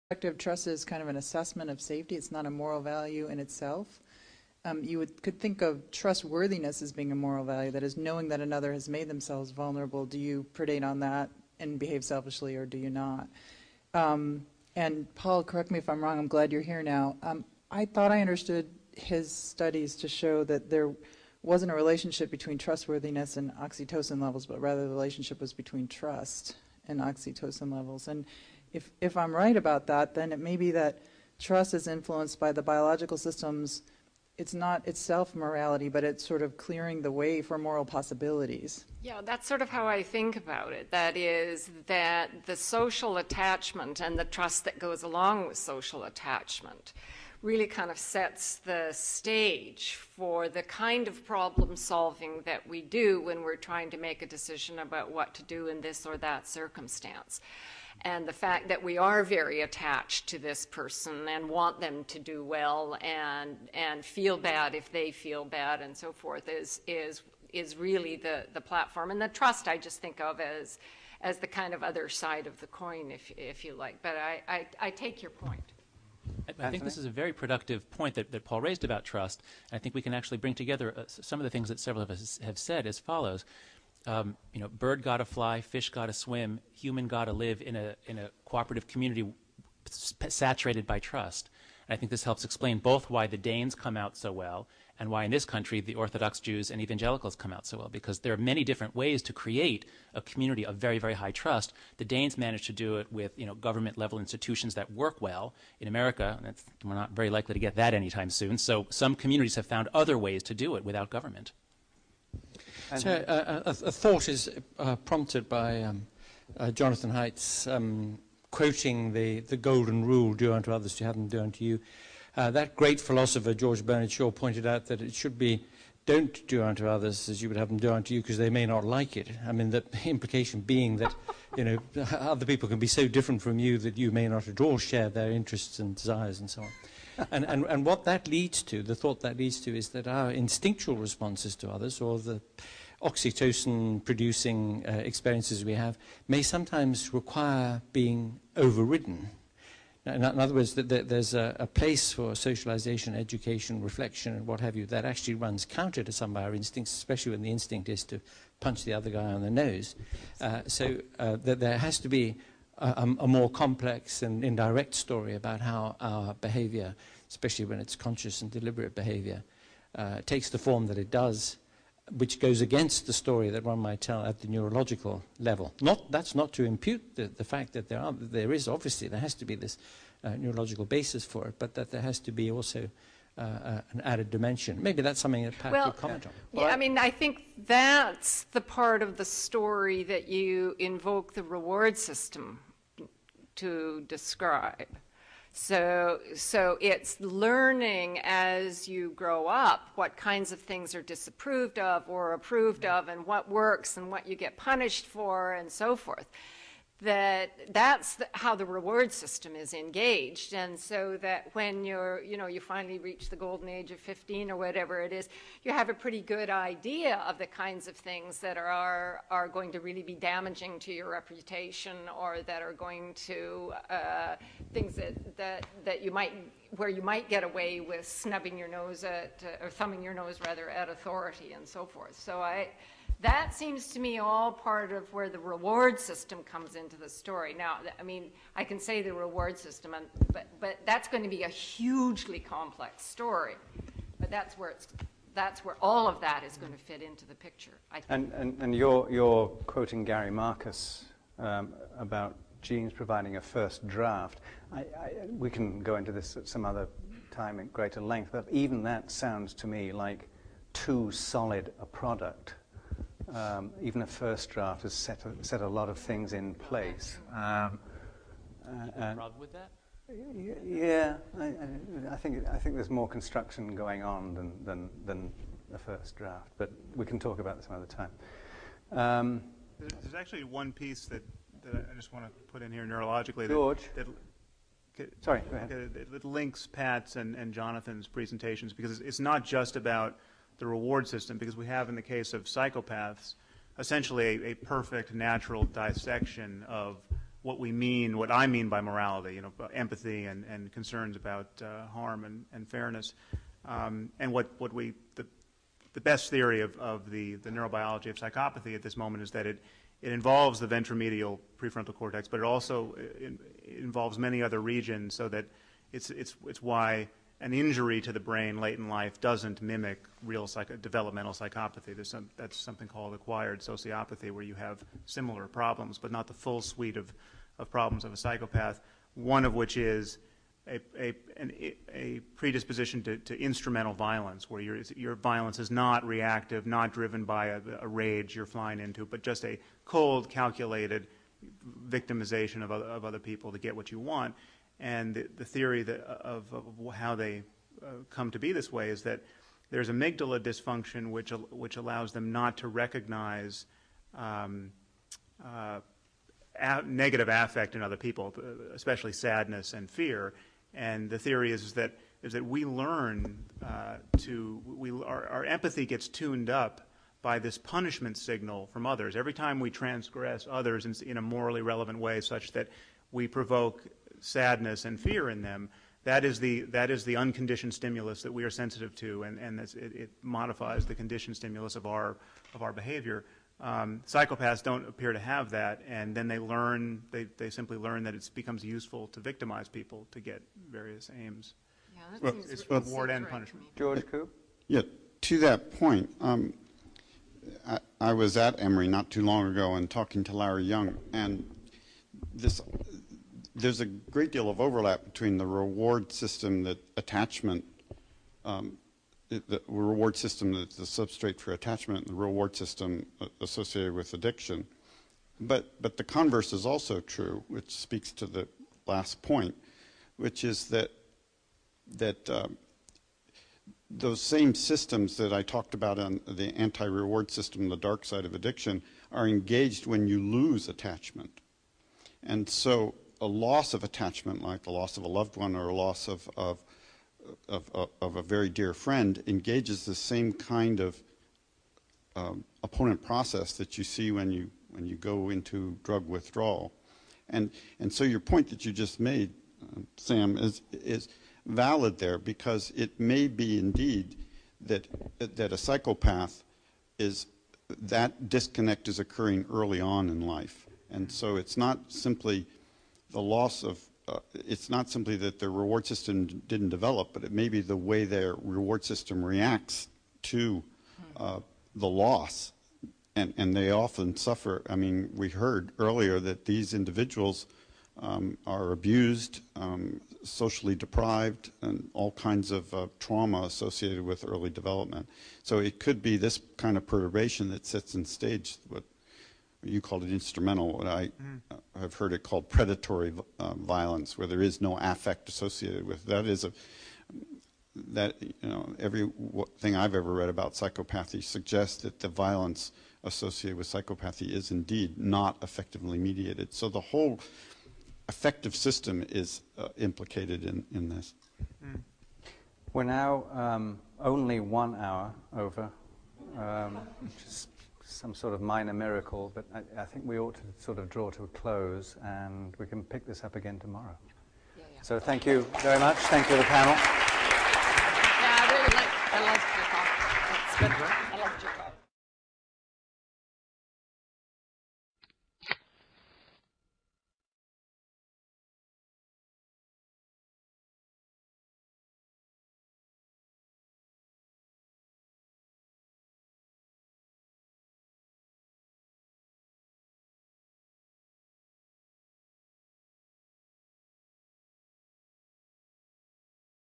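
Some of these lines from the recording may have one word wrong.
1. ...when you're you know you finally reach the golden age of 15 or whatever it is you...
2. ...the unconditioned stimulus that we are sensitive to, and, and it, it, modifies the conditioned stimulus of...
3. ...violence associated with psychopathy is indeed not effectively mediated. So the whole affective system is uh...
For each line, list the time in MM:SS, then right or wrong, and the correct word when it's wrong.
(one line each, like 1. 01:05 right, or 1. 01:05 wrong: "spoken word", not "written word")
1. 03:31 right
2. 06:17 right
3. 08:22 right.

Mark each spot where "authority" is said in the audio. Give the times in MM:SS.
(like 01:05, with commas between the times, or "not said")
03:50.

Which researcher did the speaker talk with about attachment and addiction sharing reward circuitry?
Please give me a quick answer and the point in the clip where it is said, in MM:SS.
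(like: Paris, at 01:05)
Larry Young, at 06:40.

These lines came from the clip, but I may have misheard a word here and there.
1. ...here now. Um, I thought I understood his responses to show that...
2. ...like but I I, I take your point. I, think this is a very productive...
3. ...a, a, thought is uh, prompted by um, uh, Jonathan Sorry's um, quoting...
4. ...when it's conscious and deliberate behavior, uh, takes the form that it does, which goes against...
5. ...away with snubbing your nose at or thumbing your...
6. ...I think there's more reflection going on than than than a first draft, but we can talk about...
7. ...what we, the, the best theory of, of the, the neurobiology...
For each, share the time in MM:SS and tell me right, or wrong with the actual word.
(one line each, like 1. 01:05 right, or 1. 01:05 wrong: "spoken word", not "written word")
1. 00:16 wrong: "studies", not "responses"
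2. 01:13 right
3. 01:53 wrong: "Haidt", not "Sorry"
4. 02:47 right
5. 03:47 right
6. 04:32 wrong: "construction", not "reflection"
7. 05:04 right.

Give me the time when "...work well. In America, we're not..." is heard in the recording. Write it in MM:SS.
01:44.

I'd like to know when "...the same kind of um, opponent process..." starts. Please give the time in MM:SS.
07:19.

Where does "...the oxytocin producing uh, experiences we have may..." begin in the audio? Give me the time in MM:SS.
02:22.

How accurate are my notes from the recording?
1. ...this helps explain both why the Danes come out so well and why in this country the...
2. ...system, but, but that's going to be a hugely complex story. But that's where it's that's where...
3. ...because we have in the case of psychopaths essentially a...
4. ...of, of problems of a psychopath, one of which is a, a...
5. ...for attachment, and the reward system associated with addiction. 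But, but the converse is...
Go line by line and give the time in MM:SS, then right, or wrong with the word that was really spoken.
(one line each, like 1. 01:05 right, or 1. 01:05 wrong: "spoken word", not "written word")
1. 01:32 right
2. 03:59 right
3. 04:51 right
4. 05:26 right
5. 06:51 right.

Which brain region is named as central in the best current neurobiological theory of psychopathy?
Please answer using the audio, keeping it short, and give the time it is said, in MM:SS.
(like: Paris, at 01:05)
ventromedial prefrontal cortex, at 05:10.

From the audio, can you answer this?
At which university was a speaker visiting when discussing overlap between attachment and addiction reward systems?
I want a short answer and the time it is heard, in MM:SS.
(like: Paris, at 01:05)
Emory, at 06:38.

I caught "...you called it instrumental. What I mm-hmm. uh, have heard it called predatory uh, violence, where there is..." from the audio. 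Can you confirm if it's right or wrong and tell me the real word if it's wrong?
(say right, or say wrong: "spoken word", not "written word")
right.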